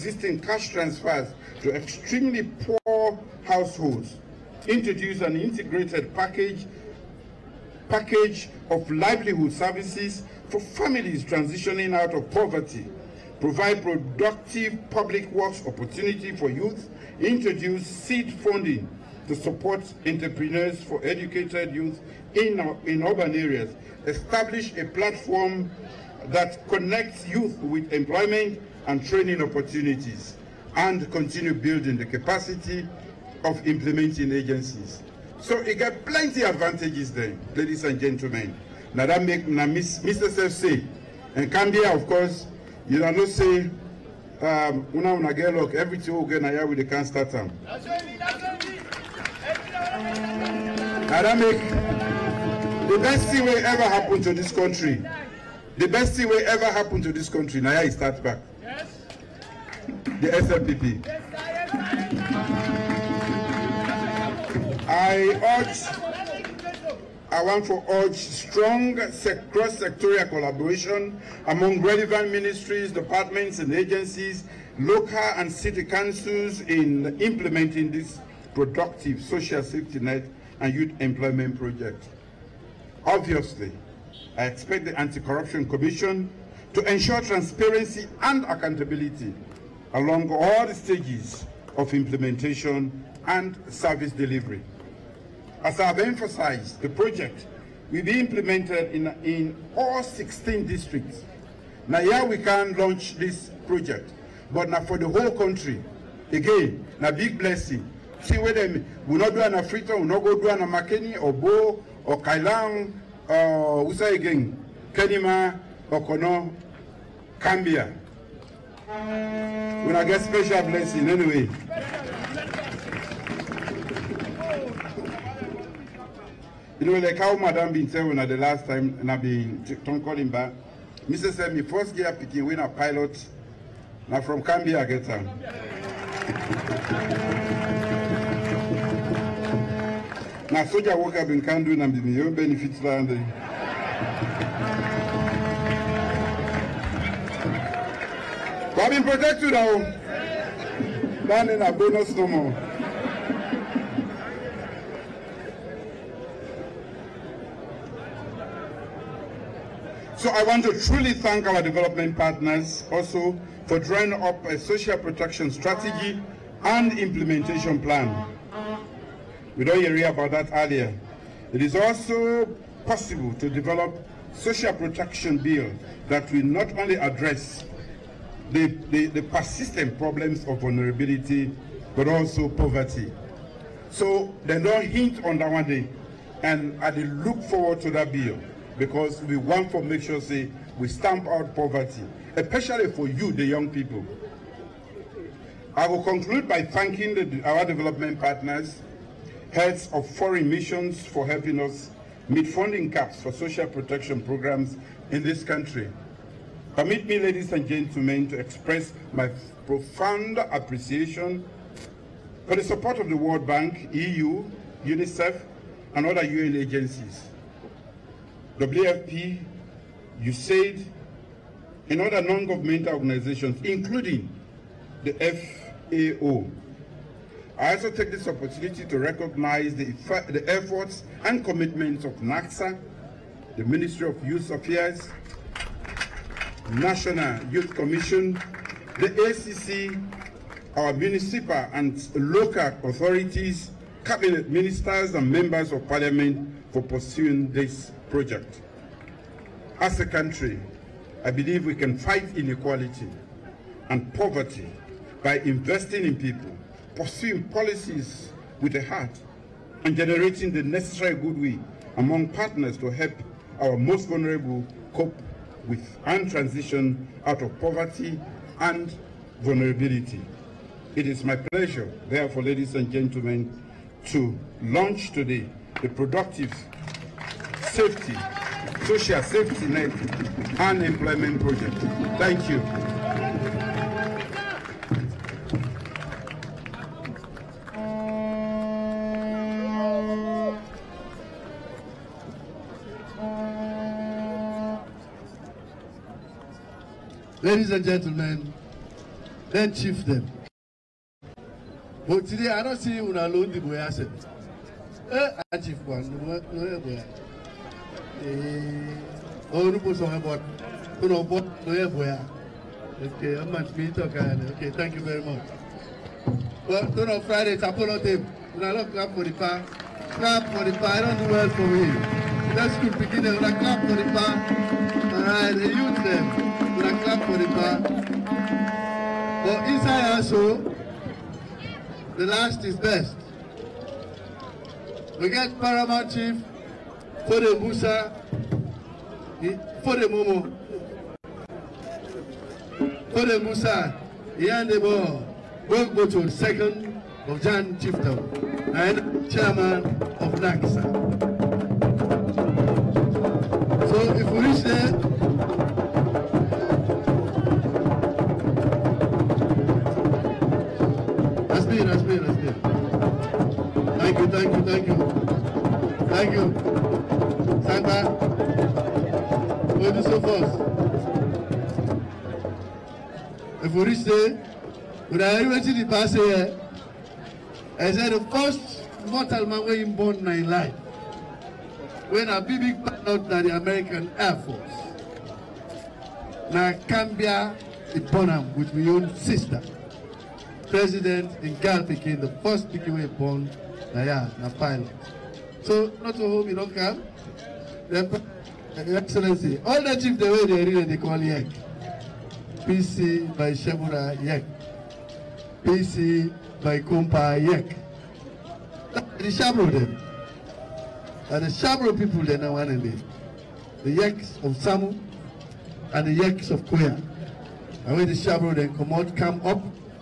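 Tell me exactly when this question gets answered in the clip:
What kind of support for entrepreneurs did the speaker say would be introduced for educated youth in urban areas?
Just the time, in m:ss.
0:17.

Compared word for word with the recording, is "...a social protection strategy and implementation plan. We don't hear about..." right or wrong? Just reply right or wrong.
right.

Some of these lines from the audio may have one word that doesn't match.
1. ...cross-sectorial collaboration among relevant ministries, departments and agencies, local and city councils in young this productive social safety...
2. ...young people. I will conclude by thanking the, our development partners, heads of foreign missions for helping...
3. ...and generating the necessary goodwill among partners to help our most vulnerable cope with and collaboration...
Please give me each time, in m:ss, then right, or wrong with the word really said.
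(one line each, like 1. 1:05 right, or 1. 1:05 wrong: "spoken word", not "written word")
1. 1:08 wrong: "implementing", not "young"
2. 3:13 right
3. 4:19 wrong: "transition", not "collaboration".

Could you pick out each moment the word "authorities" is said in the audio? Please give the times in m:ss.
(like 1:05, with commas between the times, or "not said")
4:02.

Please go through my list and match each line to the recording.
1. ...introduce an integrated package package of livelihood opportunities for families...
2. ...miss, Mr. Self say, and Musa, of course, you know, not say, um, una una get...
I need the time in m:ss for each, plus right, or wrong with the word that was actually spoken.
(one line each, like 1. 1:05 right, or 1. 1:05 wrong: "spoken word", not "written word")
1. 0:04 wrong: "services", not "opportunities"
2. 0:39 wrong: "Cambia", not "Musa".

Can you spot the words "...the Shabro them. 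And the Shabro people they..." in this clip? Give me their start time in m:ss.
6:49.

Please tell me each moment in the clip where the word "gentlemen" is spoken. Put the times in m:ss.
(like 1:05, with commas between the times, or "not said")
0:37, 3:27, 4:32, 4:57.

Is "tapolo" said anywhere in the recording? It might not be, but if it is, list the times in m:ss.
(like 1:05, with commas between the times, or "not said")
5:17.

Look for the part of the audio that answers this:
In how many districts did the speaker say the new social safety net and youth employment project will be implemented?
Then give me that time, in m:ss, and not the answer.
1:40.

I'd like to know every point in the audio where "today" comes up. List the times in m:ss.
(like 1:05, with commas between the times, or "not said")
4:35, 5:02.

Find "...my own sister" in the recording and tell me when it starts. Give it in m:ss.
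6:28.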